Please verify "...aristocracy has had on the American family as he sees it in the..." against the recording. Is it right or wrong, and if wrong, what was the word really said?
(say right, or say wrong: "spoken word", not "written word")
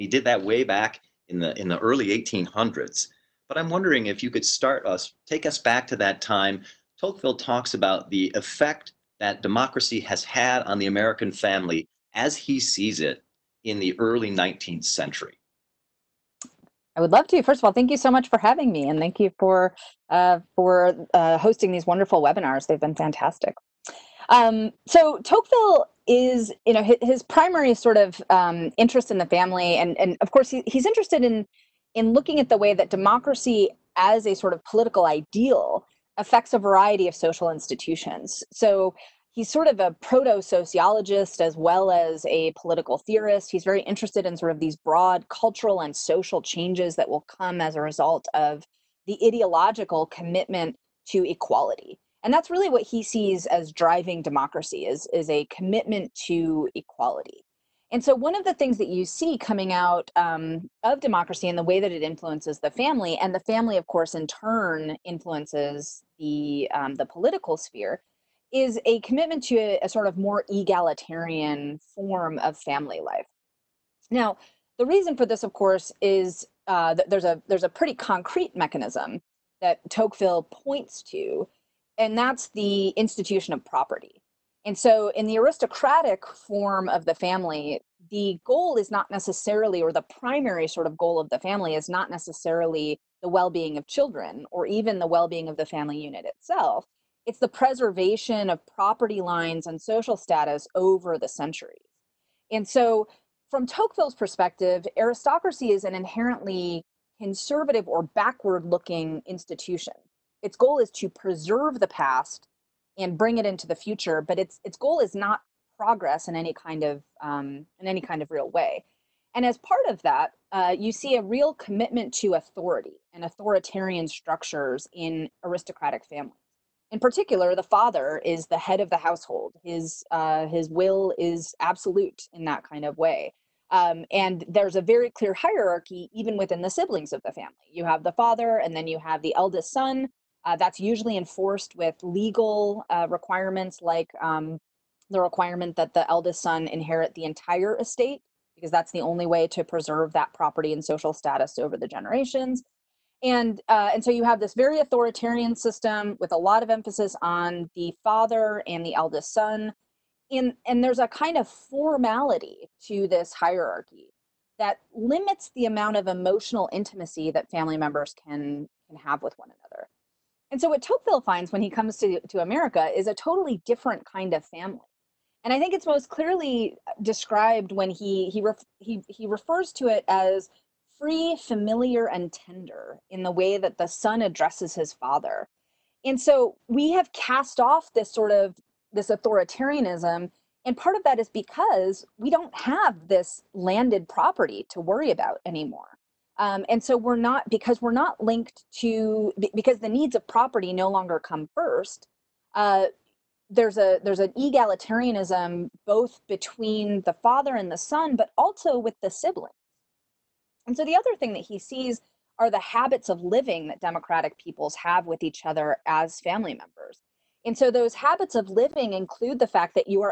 wrong: "democracy", not "aristocracy".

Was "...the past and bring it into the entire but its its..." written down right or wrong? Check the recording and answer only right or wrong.
wrong.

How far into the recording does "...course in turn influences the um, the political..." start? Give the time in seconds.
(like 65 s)
63 s.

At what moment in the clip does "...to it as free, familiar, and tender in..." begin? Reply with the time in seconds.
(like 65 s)
179 s.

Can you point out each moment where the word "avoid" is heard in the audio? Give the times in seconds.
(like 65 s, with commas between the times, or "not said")
not said.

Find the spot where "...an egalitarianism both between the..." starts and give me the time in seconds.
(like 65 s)
204 s.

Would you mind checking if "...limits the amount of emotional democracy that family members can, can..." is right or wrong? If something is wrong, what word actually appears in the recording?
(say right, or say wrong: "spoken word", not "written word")
wrong: "intimacy", not "democracy".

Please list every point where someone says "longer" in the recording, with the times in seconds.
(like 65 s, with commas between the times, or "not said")
200 s.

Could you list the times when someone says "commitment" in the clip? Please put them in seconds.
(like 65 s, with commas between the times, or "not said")
50 s, 55 s, 69 s, 121 s.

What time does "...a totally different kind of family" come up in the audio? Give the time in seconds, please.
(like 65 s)
173 s.